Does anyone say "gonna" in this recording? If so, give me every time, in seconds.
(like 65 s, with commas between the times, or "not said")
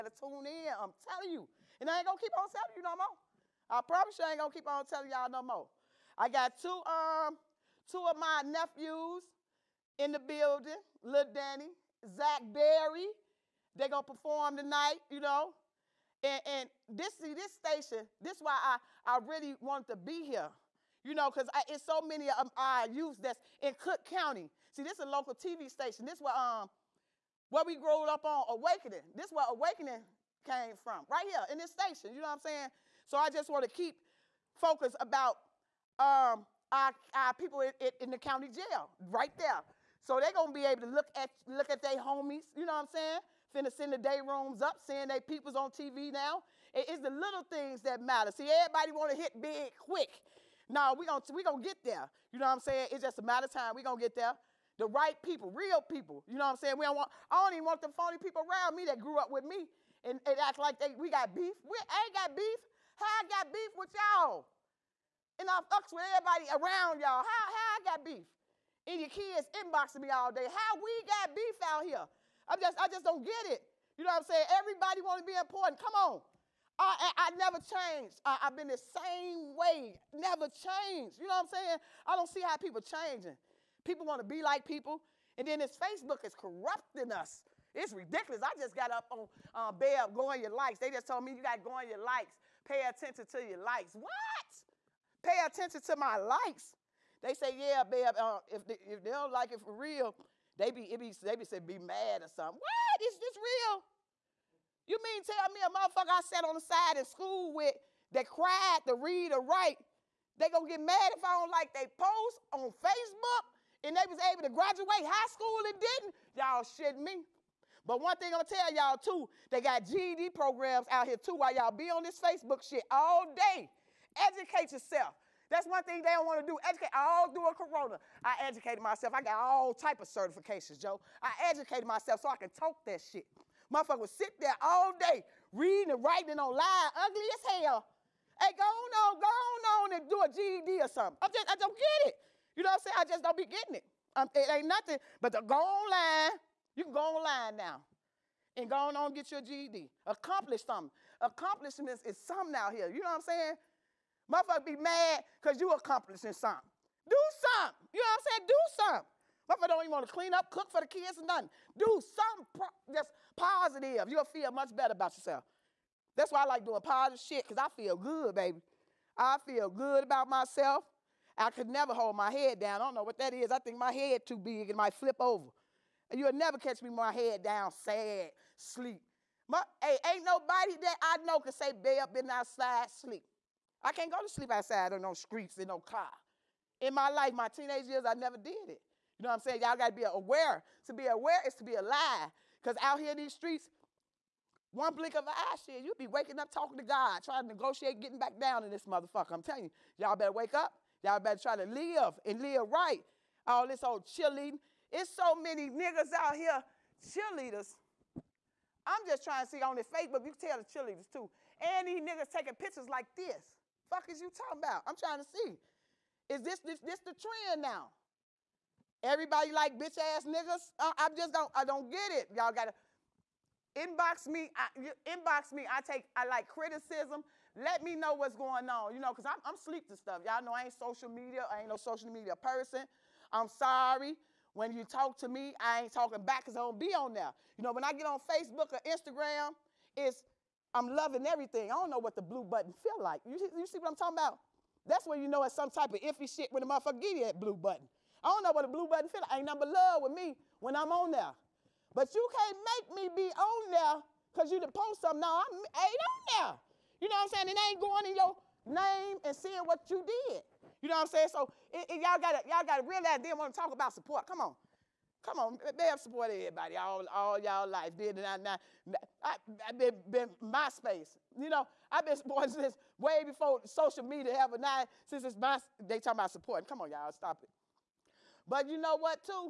40 s, 51 s, 110 s, 118 s.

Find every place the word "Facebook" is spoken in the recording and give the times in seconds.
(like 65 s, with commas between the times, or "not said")
85 s, 112 s, 122 s, 209 s, 238 s.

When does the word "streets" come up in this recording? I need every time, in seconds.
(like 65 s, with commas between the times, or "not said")
185 s, 193 s.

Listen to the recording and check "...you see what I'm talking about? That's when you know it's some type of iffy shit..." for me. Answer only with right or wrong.
right.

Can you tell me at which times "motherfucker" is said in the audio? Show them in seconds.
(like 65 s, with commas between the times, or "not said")
105 s, 133 s, 154 s, 159 s, 198 s, 246 s.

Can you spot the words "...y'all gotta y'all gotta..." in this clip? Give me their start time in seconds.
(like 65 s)
262 s.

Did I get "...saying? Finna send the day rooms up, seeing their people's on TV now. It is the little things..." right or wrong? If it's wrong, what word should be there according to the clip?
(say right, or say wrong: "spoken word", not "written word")
right.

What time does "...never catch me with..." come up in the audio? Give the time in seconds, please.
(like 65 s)
176 s.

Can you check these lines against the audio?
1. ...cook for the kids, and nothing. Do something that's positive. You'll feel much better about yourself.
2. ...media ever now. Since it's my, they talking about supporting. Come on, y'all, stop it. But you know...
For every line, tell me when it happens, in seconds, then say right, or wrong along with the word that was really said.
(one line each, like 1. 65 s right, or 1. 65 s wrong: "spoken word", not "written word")
1. 160 s right
2. 274 s right.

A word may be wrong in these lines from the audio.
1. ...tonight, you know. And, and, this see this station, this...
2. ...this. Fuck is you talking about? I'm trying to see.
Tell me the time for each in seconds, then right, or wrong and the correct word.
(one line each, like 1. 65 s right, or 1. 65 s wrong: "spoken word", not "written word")
1. 14 s right
2. 213 s right.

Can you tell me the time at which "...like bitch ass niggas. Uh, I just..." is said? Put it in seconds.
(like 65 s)
219 s.